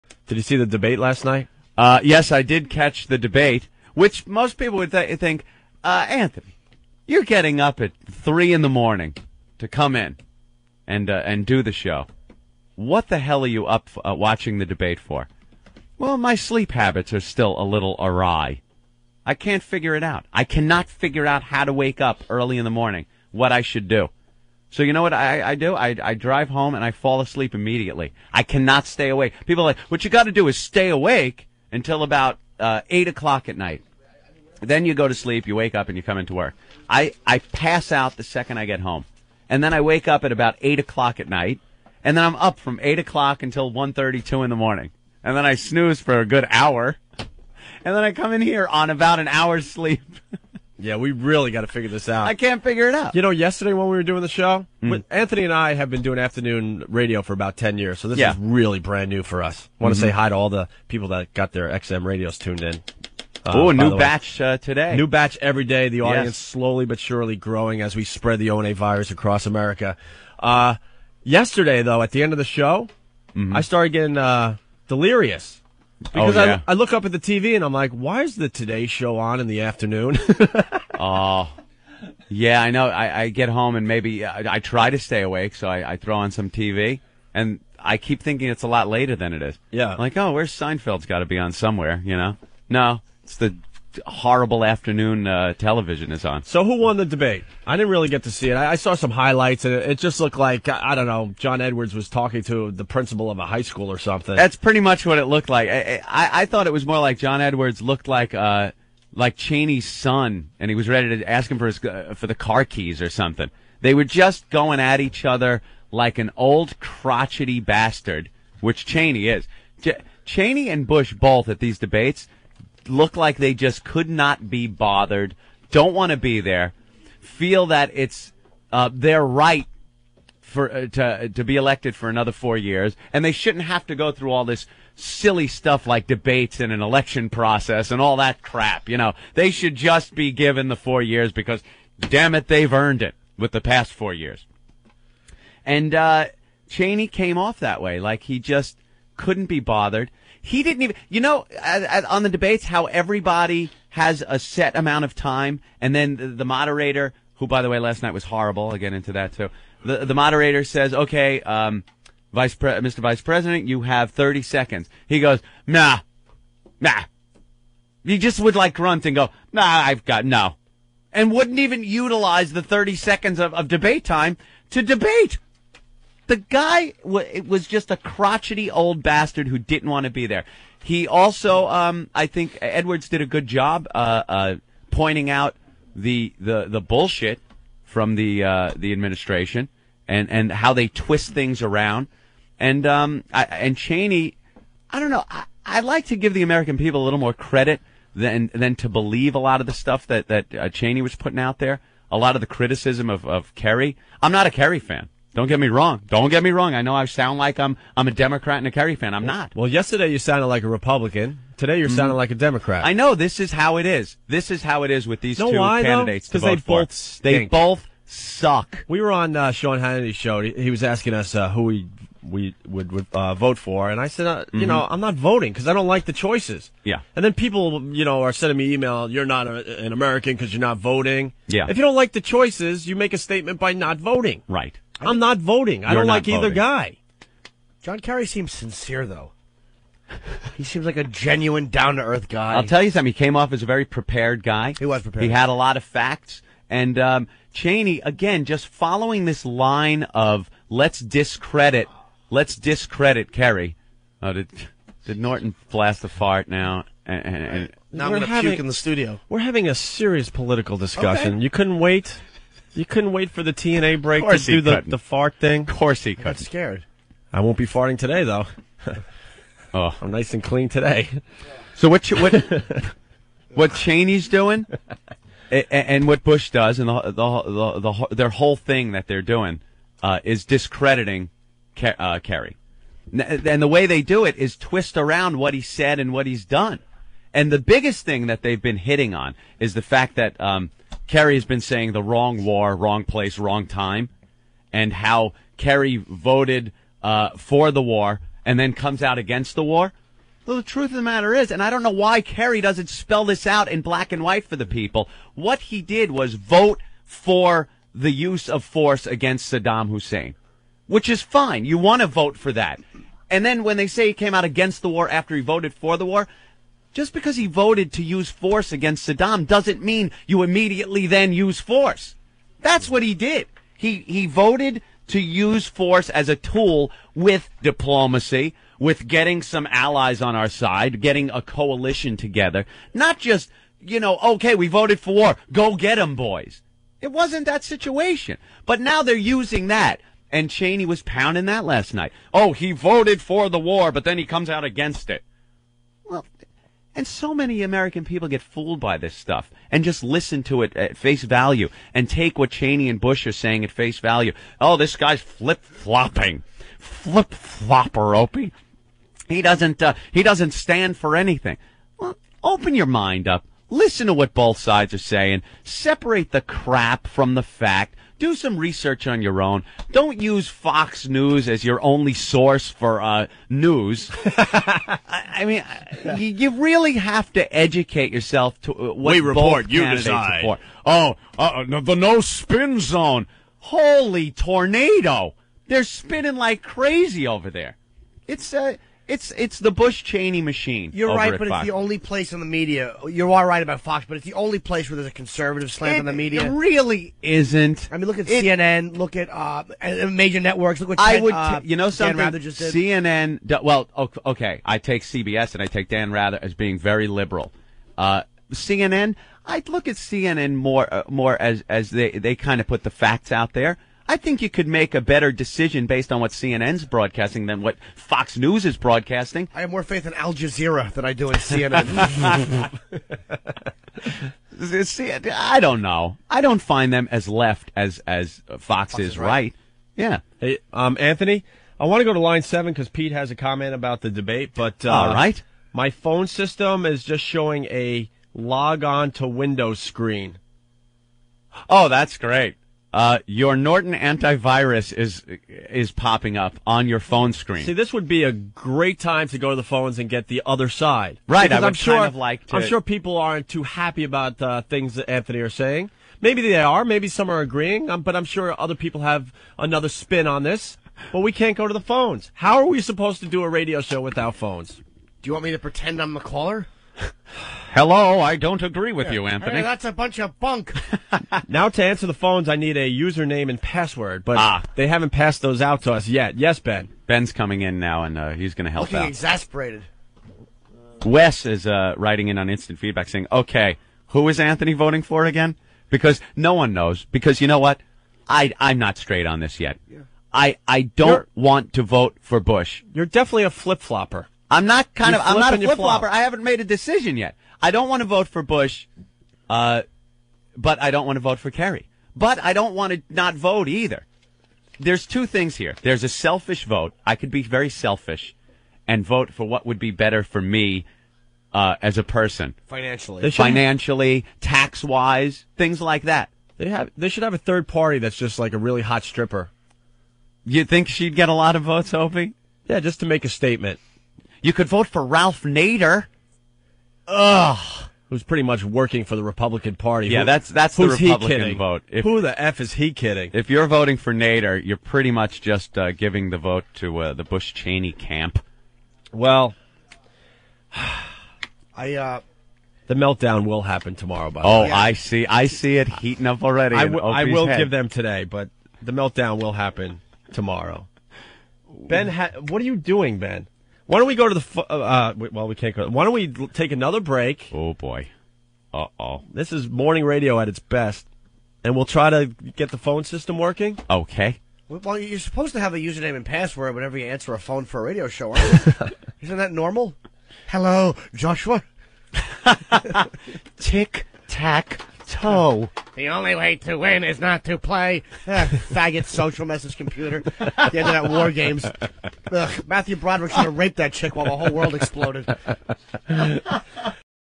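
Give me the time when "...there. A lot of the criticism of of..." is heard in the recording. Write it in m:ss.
3:21.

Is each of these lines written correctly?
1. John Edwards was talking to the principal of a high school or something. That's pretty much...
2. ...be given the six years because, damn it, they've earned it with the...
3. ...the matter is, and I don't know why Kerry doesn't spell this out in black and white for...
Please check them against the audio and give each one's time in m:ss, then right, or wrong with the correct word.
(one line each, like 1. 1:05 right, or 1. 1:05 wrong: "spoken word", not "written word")
1. 1:41 right
2. 2:20 wrong: "four", not "six"
3. 5:00 right.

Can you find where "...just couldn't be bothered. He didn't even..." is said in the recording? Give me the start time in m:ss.
2:28.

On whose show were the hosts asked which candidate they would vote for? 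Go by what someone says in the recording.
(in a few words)
Sean Hannity.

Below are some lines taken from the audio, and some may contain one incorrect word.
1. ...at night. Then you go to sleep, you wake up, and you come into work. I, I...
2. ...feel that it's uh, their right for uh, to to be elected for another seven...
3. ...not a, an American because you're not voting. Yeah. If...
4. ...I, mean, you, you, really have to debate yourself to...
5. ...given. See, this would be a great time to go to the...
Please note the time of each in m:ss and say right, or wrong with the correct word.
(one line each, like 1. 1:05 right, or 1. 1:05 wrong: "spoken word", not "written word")
1. 0:33 right
2. 2:07 wrong: "four", not "seven"
3. 3:49 right
4. 6:14 wrong: "educate", not "debate"
5. 7:27 wrong: "screen", not "given".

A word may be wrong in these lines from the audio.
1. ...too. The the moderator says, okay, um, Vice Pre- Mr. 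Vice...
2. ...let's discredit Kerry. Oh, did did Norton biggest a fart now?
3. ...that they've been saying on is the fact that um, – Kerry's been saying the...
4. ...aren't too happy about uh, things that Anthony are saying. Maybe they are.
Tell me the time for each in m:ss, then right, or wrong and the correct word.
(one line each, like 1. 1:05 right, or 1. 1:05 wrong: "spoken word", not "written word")
1. 2:39 right
2. 4:12 wrong: "blast", not "biggest"
3. 4:48 wrong: "hitting", not "saying"
4. 7:33 right.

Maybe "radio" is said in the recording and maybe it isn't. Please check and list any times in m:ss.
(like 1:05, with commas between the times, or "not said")
0:56, 1:02, 7:43, 9:20, 9:27.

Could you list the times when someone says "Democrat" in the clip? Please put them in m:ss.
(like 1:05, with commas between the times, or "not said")
3:28, 3:32.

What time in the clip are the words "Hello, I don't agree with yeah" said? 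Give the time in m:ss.
7:47.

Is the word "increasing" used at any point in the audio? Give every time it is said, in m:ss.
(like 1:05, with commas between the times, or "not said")
not said.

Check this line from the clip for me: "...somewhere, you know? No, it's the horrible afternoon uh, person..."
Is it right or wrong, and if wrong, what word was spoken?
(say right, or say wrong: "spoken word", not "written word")
wrong: "television", not "person".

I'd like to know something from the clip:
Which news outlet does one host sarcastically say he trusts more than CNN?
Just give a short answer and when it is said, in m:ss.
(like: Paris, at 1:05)
Al Jazeera, at 7:00.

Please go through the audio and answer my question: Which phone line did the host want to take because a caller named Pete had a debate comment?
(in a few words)
Line 7.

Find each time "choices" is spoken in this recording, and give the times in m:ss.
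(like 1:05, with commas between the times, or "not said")
3:46, 3:52.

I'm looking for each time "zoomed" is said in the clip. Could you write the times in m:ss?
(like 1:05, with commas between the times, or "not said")
not said.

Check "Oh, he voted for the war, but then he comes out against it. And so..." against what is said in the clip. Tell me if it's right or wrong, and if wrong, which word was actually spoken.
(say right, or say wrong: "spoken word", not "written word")
right.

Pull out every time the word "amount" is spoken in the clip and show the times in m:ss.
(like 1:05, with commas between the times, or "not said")
2:34.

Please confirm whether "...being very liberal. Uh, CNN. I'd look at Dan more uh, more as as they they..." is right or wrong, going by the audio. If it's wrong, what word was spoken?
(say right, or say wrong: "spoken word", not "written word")
wrong: "CNN", not "Dan".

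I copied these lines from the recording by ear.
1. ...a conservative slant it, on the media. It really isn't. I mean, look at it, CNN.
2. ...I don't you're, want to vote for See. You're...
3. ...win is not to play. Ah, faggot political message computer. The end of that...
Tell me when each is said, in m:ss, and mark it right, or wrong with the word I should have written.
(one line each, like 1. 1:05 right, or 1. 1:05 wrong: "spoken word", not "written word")
1. 6:35 right
2. 8:10 wrong: "Bush", not "See"
3. 9:36 wrong: "social", not "political".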